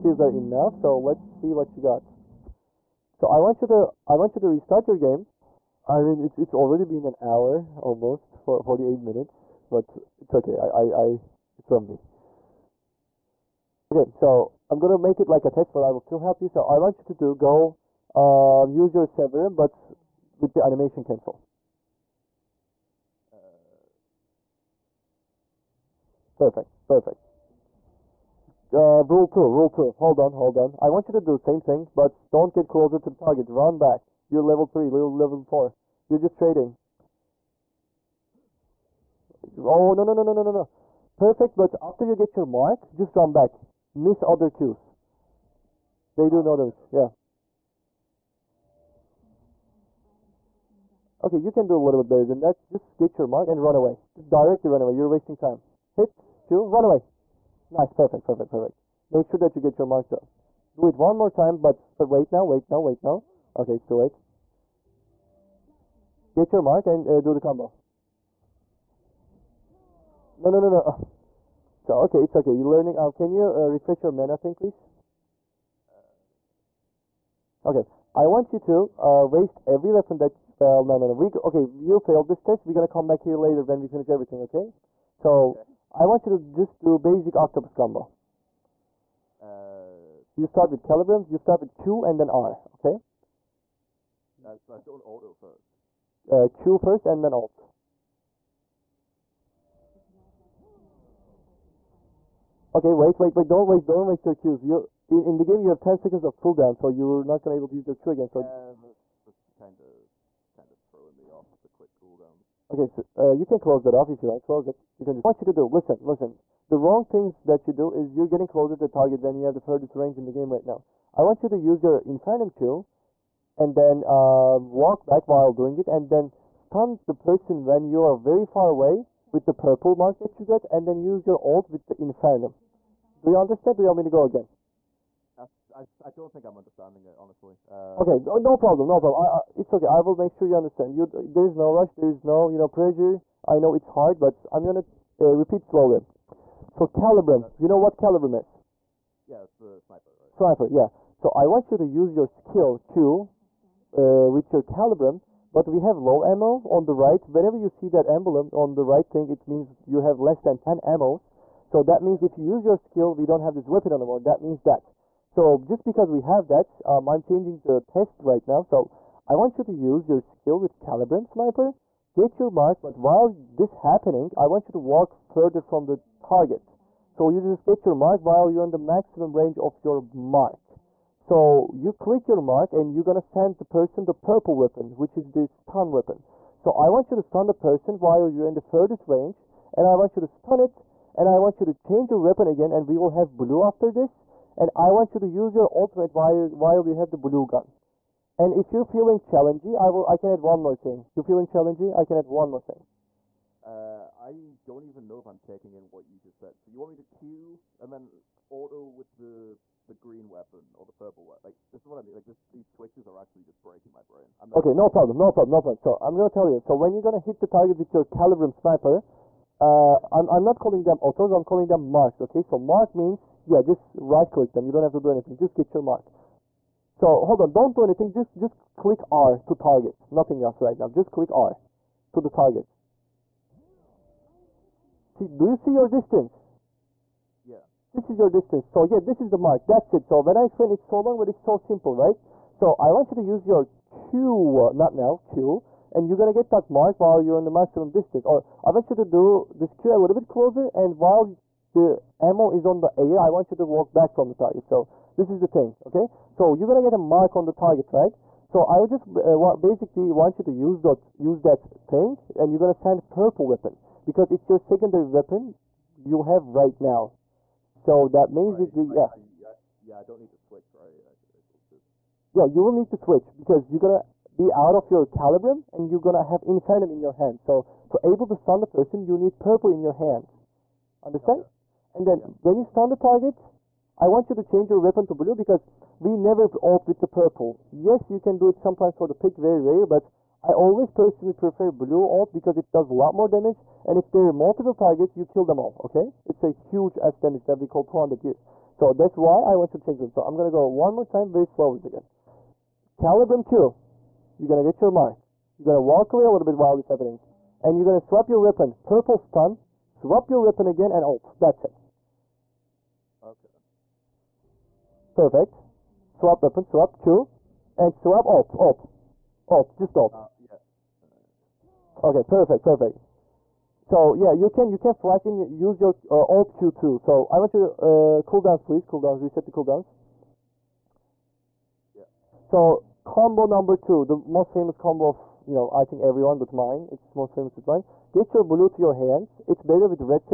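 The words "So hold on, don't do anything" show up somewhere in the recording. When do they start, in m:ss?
3:46.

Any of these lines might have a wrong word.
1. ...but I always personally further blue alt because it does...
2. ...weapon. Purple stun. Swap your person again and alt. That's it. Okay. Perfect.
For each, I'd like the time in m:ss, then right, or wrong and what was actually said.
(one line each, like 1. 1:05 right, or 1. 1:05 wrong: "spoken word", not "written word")
1. 4:49 wrong: "prefer", not "further"
2. 5:08 wrong: "weapon", not "person".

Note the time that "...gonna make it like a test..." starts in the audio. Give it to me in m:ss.
0:14.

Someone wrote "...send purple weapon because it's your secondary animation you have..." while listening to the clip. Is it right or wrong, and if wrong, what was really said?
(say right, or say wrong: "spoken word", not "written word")
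wrong: "weapon", not "animation".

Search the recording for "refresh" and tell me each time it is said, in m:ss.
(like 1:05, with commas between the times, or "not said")
1:13.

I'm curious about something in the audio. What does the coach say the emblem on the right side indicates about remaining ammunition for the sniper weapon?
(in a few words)
Less than 10 ammos.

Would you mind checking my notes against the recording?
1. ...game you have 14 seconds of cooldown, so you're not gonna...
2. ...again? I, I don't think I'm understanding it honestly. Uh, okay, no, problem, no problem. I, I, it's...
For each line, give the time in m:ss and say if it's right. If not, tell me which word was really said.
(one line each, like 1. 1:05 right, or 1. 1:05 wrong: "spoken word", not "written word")
1. 1:45 wrong: "10", not "14"
2. 2:14 right.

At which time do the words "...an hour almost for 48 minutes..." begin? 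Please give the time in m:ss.
0:07.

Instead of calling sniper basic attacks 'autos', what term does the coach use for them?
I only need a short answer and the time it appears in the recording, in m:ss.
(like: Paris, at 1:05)
Marks, at 3:41.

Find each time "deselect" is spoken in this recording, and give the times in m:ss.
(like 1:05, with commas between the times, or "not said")
not said.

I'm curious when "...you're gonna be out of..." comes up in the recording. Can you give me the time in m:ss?
4:33.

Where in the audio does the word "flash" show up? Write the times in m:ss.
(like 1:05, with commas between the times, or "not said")
5:24.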